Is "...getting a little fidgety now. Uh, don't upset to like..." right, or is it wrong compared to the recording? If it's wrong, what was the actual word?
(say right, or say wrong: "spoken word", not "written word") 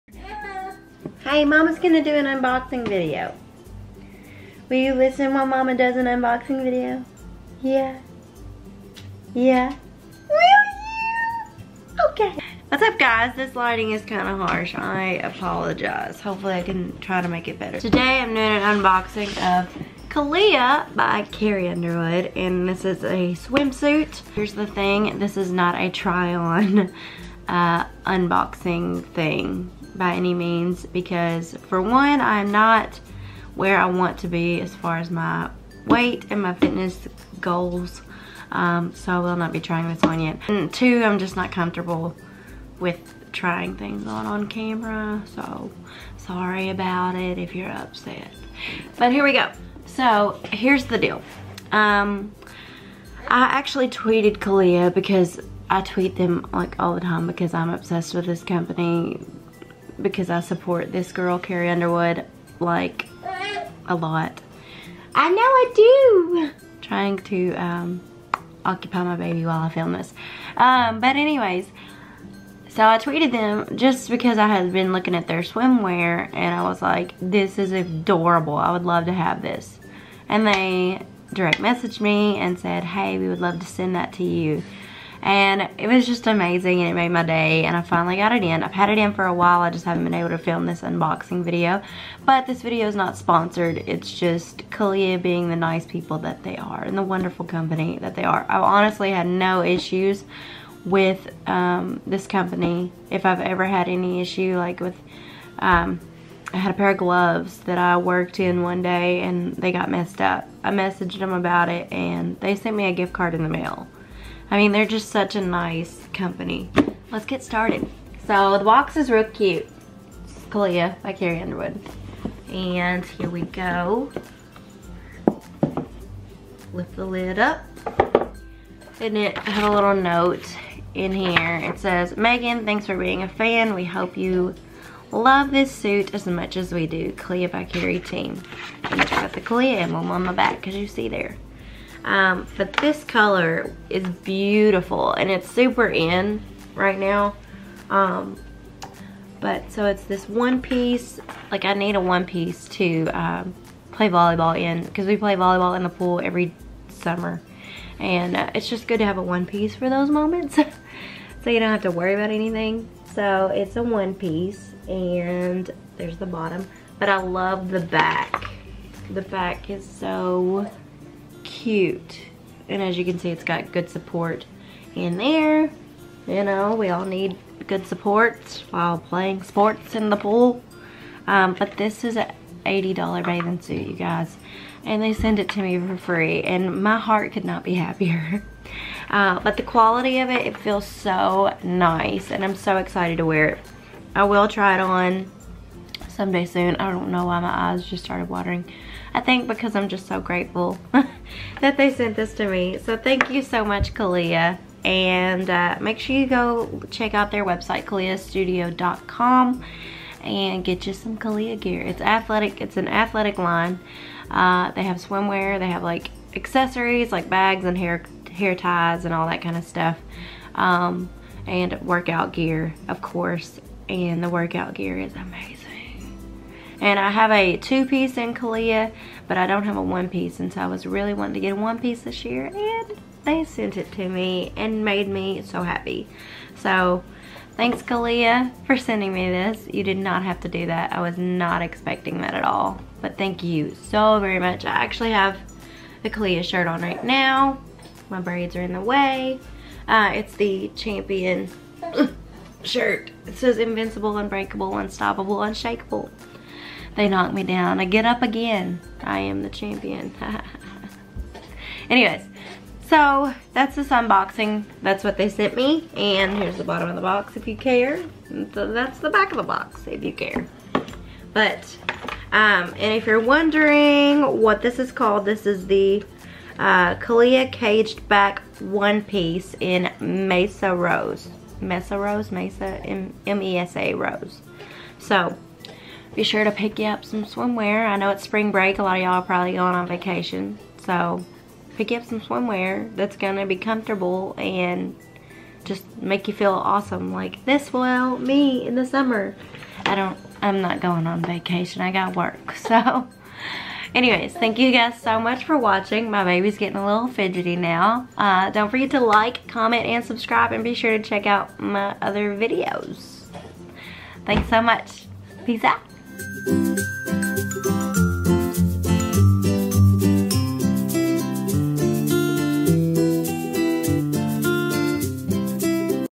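wrong: "forget", not "upset".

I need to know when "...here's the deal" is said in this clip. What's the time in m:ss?
0:50.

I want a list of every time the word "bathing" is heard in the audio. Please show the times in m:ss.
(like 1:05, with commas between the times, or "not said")
3:03.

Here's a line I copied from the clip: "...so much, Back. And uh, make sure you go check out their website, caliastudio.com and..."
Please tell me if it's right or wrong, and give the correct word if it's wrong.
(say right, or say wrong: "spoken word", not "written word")
wrong: "Calia", not "Back".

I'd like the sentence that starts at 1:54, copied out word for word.
I mean, they're just such a nice company.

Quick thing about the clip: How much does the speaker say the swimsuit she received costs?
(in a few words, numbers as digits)
$80.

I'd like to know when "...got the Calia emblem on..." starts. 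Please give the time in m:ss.
2:19.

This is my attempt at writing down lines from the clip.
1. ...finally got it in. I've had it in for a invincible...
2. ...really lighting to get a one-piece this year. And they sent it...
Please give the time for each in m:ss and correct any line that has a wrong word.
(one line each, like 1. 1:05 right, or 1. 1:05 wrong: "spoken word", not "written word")
1. 1:27 wrong: "while", not "invincible"
2. 3:50 wrong: "wanting", not "lighting".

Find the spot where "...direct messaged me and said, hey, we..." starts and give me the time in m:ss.
1:21.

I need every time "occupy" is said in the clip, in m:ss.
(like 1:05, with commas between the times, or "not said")
1:08.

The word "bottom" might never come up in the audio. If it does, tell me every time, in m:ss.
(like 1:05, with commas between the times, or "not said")
2:46, 4:26.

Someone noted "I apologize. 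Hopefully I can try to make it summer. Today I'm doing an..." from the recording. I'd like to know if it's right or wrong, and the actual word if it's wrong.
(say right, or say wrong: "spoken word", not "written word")
wrong: "better", not "summer".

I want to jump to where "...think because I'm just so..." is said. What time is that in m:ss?
3:19.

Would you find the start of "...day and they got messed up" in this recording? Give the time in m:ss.
1:48.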